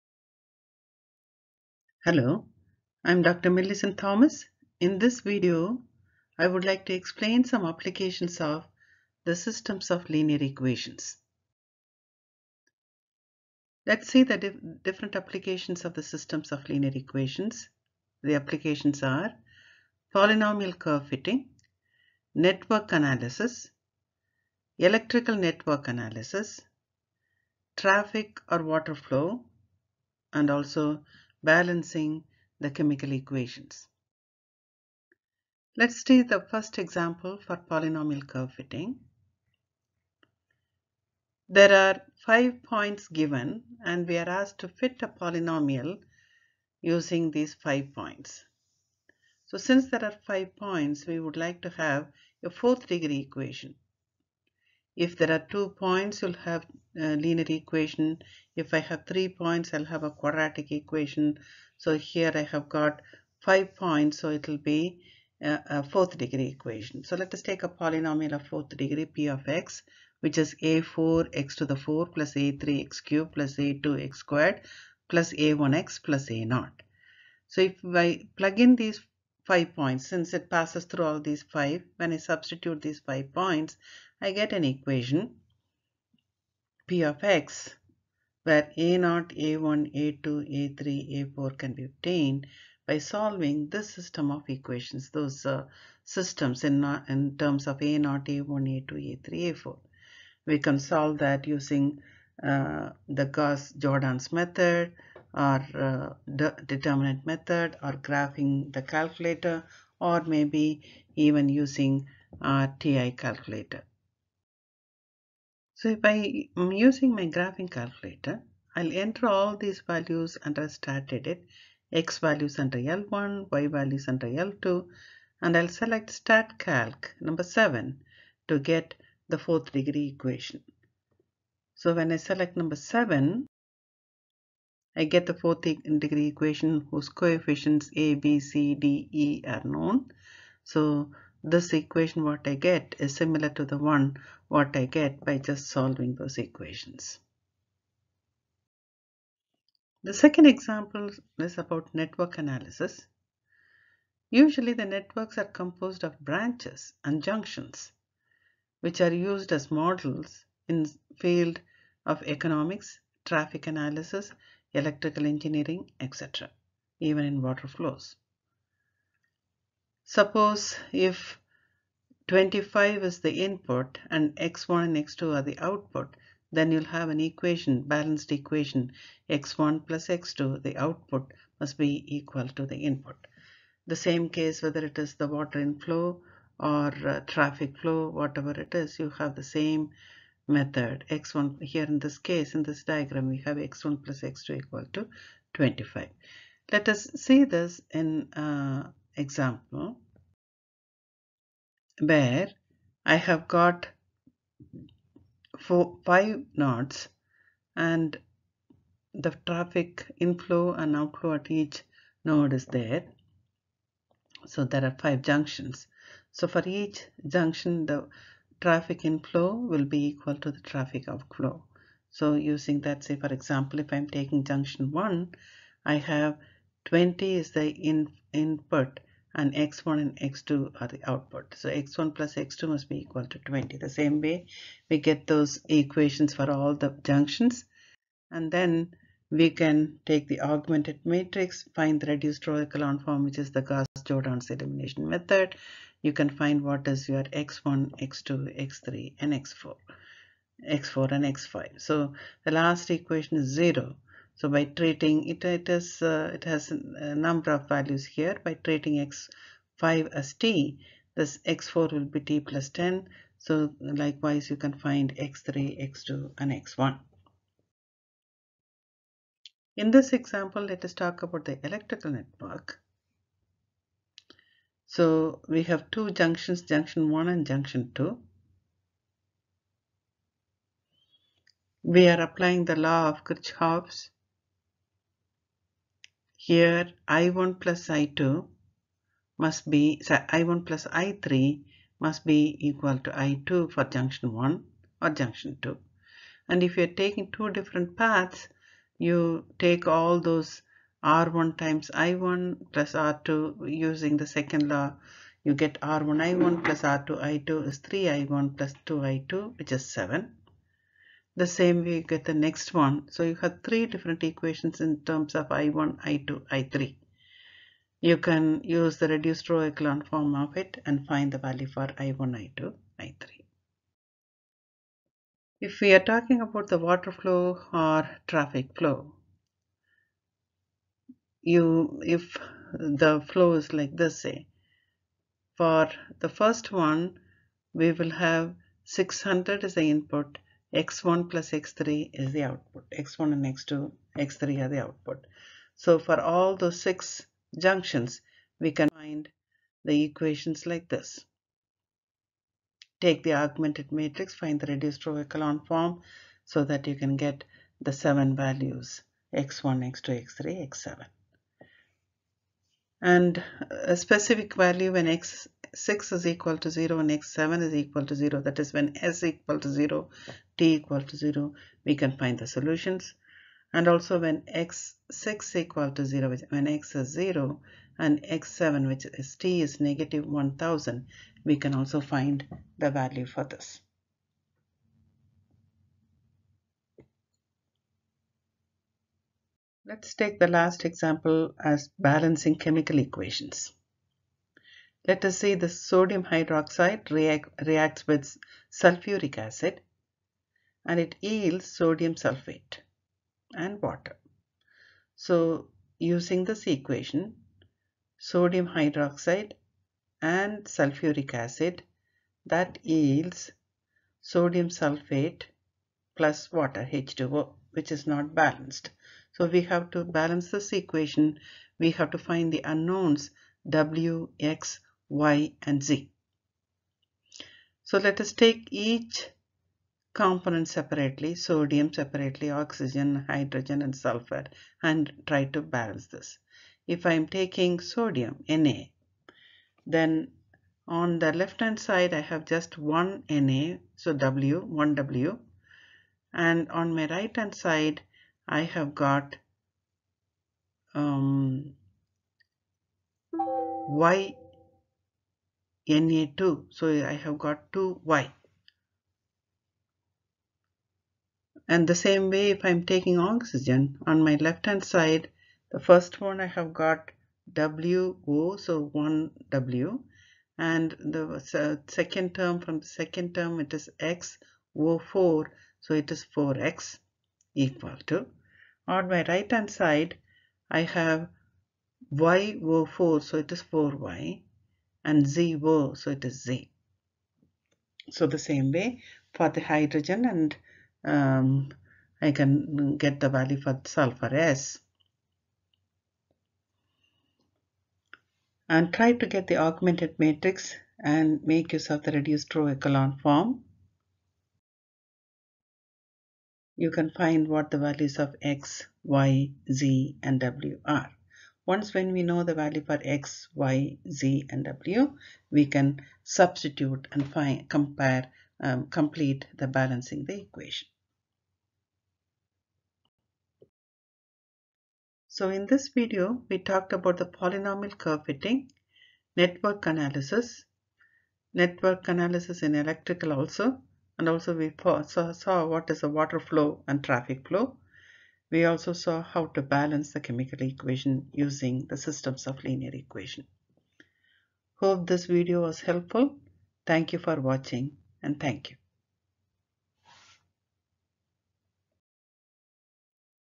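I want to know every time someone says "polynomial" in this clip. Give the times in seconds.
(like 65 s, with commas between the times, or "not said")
20 s, 37 s, 45 s, 67 s, 527 s.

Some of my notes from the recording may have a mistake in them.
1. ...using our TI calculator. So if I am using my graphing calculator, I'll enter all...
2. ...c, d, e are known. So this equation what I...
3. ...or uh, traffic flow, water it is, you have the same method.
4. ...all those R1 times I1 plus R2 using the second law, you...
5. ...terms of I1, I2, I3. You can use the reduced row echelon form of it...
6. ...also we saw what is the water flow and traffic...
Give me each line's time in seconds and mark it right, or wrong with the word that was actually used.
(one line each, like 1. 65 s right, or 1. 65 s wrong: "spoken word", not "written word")
1. 111 s right
2. 138 s right
3. 186 s wrong: "whatever", not "water"
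4. 299 s right
5. 315 s right
6. 534 s right.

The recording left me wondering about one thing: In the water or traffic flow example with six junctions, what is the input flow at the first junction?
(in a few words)
600.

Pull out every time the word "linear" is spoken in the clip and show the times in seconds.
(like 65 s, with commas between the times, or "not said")
10 s, 16 s, 57 s, 542 s.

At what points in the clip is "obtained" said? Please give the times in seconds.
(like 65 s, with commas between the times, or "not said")
91 s.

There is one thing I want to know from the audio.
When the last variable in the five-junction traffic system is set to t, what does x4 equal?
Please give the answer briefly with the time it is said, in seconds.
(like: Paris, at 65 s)
t plus 10, at 262 s.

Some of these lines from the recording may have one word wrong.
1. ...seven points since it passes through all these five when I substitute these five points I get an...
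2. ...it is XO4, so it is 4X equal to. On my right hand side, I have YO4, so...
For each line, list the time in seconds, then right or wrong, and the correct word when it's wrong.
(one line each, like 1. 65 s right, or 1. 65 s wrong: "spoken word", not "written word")
1. 79 s wrong: "five", not "seven"
2. 473 s right.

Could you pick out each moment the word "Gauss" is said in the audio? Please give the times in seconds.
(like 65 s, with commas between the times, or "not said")
103 s, 243 s.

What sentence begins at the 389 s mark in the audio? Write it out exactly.
Let's take the last example as balancing chemical equations.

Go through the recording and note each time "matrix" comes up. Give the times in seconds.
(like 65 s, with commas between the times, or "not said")
241 s, 353 s, 500 s.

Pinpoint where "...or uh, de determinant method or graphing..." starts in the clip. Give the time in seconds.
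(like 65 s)
105 s.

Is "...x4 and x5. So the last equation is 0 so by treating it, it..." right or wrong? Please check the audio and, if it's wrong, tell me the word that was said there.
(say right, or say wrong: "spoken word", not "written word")
right.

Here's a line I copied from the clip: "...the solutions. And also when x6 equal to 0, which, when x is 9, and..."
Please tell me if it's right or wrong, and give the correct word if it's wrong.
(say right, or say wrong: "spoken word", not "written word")
wrong: "0", not "9".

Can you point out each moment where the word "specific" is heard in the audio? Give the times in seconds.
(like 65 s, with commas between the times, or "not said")
363 s.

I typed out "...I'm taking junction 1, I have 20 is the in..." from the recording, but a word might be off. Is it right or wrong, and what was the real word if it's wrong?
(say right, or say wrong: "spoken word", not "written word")
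right.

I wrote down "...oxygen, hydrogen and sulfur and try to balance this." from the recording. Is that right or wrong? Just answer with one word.
right.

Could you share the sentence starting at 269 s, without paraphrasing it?
In this example, let us talk about the electrical network.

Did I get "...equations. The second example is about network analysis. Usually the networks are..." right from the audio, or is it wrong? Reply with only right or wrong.
right.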